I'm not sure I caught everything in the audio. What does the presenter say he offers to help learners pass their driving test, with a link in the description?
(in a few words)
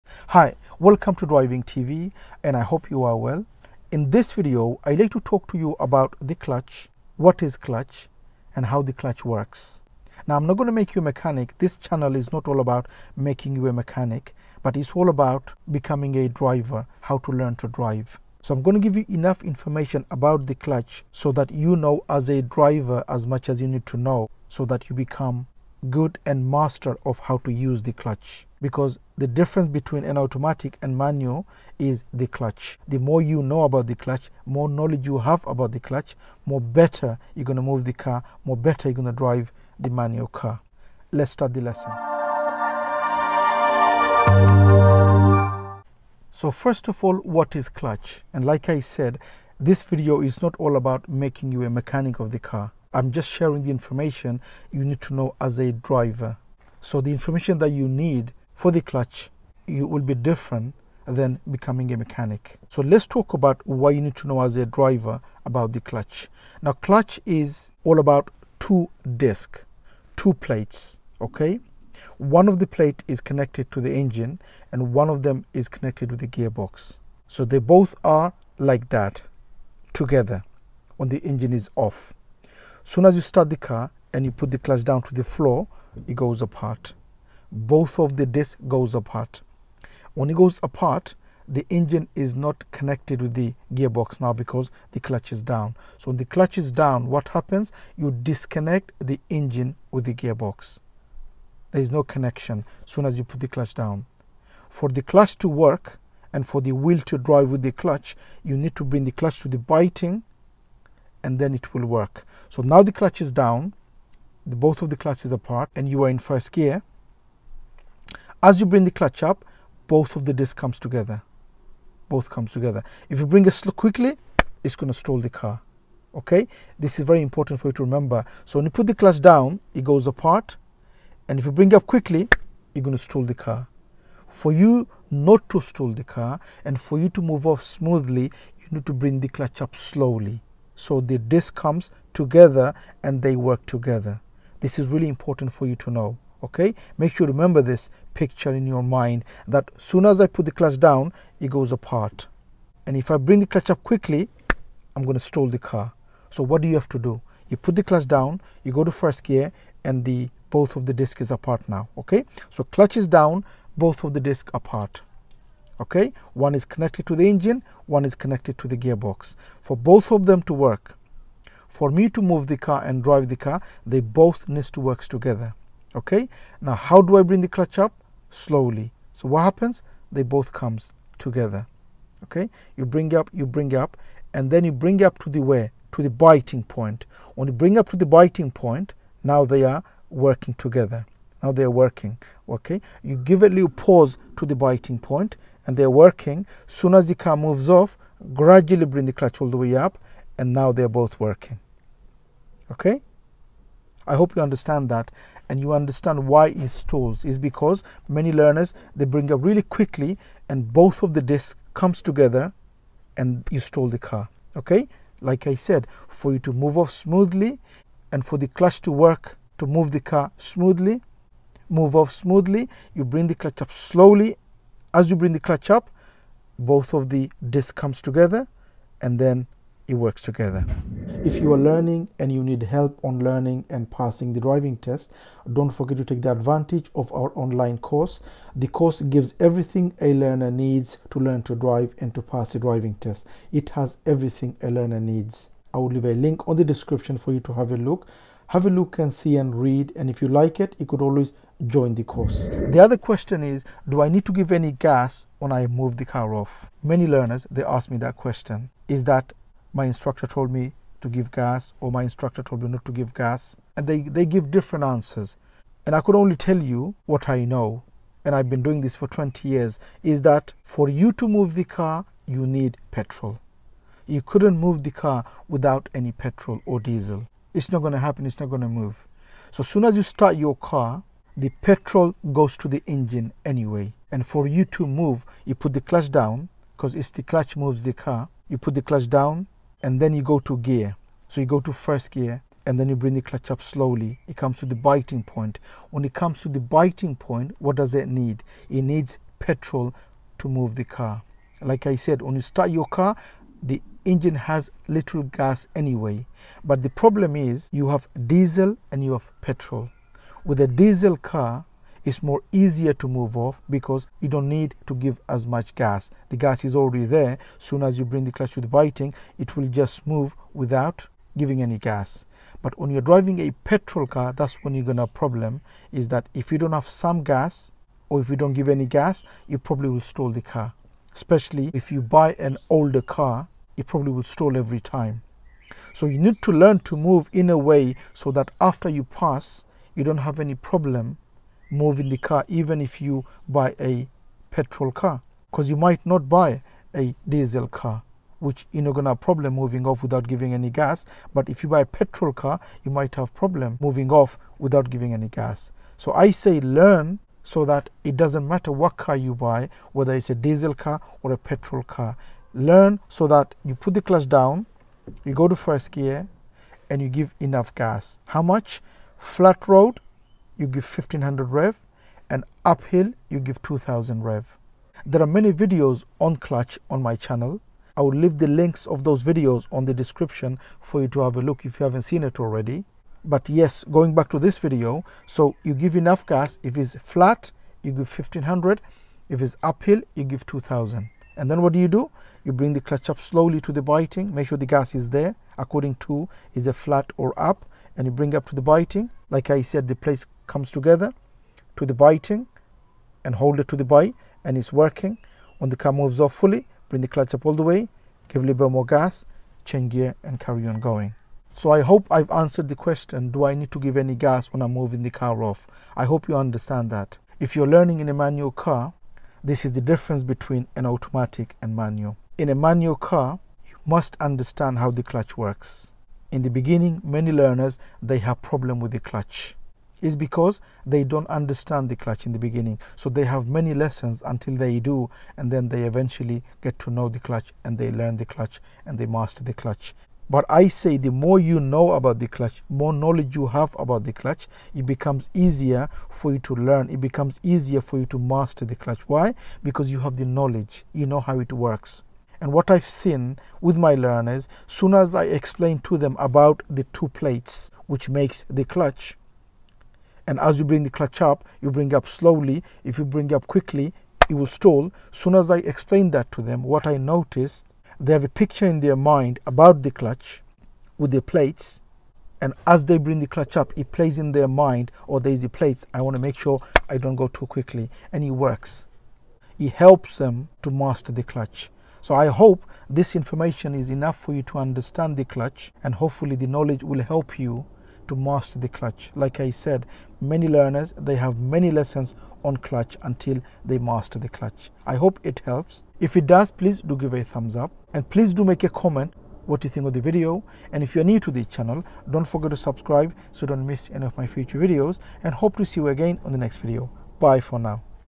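online course.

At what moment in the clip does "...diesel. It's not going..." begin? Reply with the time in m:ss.
4:36.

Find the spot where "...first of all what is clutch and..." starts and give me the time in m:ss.
0:46.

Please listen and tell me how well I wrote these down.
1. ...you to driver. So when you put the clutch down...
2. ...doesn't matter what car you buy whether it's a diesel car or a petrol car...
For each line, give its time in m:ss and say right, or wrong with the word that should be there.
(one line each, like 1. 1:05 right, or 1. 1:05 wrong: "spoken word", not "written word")
1. 2:07 wrong: "remember", not "driver"
2. 5:58 right.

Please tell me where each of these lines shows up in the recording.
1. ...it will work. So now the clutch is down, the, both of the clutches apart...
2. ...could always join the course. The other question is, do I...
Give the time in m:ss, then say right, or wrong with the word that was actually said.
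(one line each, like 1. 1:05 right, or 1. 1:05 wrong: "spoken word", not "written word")
1. 1:51 right
2. 4:10 right.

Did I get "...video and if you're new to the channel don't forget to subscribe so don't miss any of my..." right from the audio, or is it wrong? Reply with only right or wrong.
right.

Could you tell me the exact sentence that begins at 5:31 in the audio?
Especially if you buy an older car, it probably will stall every time.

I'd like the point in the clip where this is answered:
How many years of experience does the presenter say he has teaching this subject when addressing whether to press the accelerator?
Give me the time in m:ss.
4:29.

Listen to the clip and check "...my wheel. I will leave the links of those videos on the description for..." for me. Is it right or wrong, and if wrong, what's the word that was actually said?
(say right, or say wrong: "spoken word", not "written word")
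wrong: "channel", not "wheel".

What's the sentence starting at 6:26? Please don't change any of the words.
If it's flat, you give 1500.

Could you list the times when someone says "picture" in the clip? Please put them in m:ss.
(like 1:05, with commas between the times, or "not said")
2:28, 7:48.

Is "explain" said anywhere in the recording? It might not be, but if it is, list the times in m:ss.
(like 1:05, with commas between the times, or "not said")
7:35, 7:45.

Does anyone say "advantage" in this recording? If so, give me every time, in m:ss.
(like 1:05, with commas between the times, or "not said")
3:56.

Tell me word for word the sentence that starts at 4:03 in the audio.
It has everything a learner needs.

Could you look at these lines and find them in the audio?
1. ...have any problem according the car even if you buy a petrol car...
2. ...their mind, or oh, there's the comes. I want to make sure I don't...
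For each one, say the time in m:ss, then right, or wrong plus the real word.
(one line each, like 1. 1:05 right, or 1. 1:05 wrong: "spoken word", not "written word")
1. 5:40 wrong: "moving", not "according"
2. 7:54 wrong: "plates", not "comes".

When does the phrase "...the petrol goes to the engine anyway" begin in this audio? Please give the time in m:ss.
4:41.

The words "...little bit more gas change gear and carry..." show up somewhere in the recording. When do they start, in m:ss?
6:48.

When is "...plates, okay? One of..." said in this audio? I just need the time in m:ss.
1:10.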